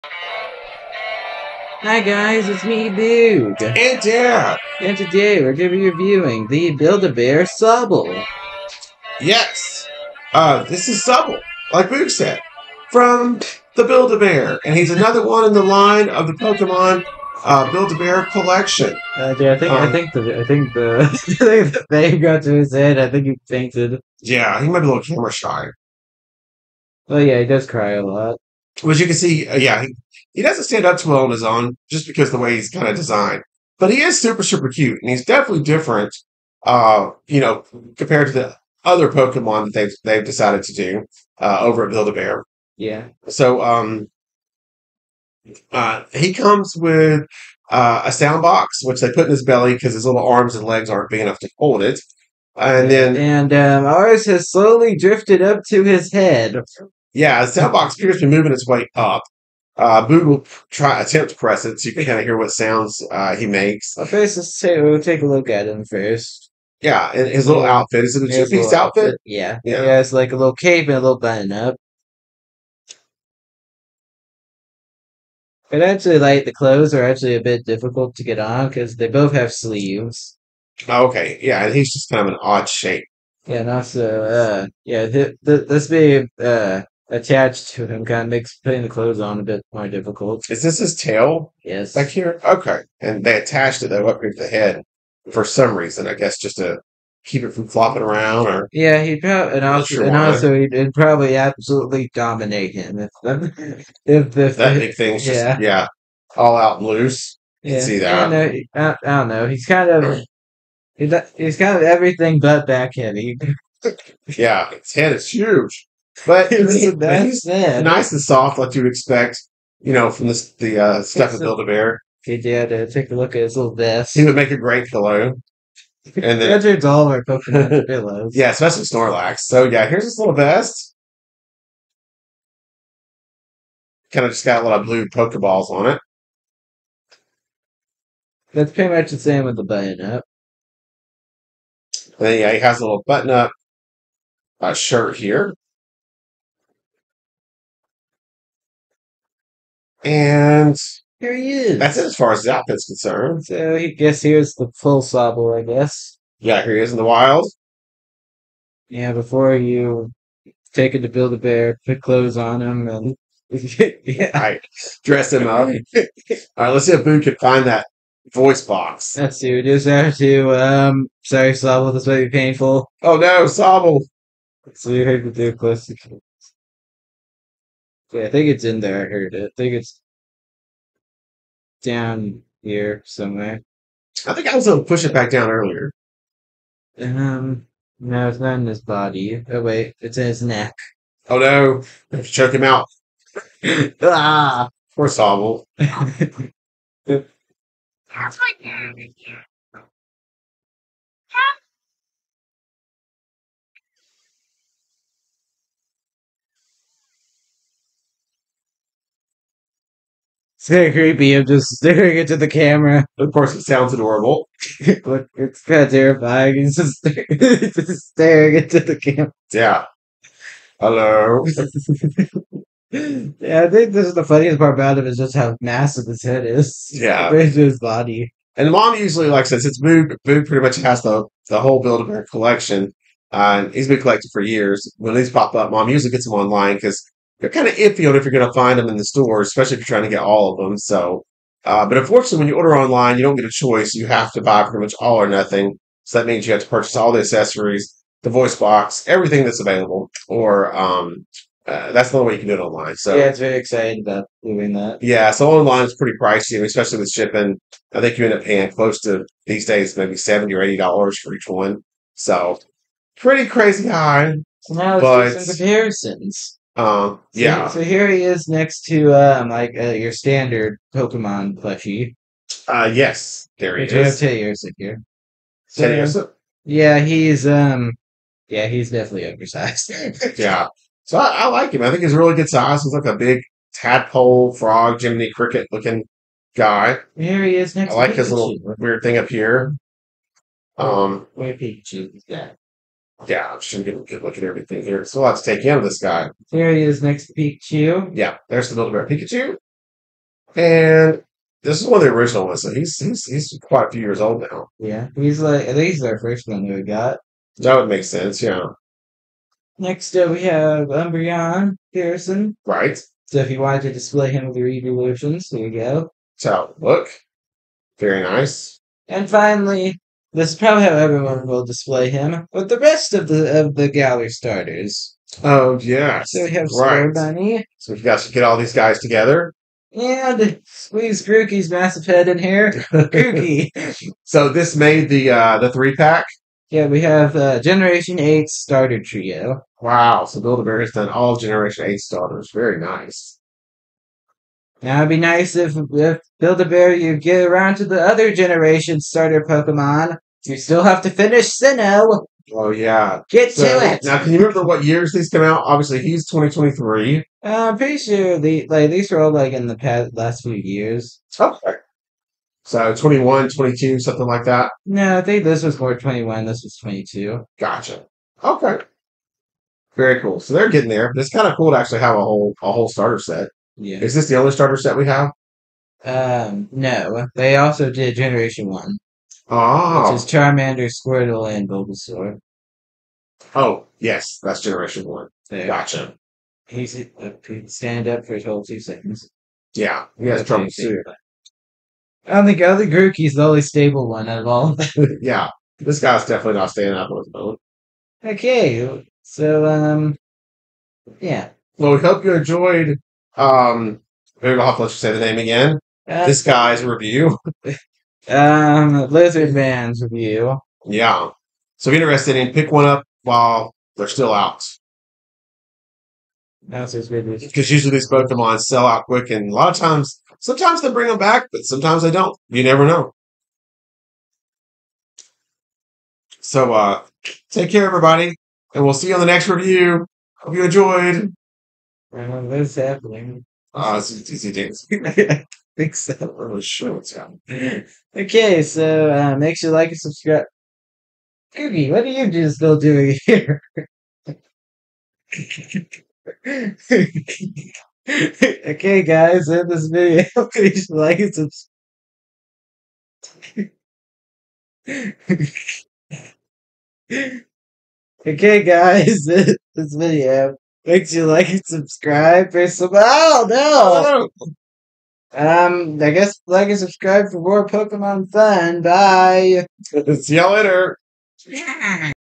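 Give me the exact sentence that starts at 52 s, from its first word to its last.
And then and um, ours has slowly drifted up to his head.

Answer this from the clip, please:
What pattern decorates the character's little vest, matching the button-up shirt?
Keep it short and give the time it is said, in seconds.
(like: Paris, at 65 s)
blue Pokeballs, at 134 s.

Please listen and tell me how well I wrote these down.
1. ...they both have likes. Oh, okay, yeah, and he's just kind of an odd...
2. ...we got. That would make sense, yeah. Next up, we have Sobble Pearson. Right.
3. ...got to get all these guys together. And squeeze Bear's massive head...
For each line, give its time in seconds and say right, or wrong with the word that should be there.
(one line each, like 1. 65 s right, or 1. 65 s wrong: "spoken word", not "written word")
1. 78 s wrong: "sleeves", not "likes"
2. 306 s wrong: "Umbreon", not "Sobble"
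3. 328 s wrong: "Grookey", not "Bear".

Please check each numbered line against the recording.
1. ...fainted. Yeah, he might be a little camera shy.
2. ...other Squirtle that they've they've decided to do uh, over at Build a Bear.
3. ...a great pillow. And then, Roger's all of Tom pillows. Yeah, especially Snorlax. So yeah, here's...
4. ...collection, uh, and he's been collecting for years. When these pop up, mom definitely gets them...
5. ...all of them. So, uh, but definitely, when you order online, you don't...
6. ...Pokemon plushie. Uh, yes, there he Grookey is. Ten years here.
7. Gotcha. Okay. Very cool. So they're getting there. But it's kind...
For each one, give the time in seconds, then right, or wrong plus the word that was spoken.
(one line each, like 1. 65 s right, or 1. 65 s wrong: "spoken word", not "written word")
1. 23 s right
2. 38 s wrong: "Pokemon", not "Squirtle"
3. 124 s wrong: "Pokemon", not "Tom"
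4. 232 s wrong: "usually", not "definitely"
5. 240 s wrong: "unfortunately", not "definitely"
6. 270 s wrong: "Which", not "Grookey"
7. 367 s right.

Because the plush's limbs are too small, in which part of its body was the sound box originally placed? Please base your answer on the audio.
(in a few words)
belly.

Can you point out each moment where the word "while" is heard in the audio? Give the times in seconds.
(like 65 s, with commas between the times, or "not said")
413 s.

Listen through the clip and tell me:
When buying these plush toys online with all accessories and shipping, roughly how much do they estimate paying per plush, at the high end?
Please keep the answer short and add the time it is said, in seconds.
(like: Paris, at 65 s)
$80, at 260 s.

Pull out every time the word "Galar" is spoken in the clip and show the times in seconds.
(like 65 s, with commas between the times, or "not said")
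323 s.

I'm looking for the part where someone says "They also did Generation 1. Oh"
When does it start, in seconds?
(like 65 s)
377 s.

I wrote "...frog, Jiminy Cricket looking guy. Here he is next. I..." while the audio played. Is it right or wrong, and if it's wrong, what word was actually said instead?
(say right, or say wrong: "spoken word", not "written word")
right.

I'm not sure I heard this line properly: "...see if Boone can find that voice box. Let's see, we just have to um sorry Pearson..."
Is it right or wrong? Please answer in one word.
wrong.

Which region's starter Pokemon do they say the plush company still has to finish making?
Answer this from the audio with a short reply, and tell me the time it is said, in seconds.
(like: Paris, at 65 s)
Sinnoh, at 351 s.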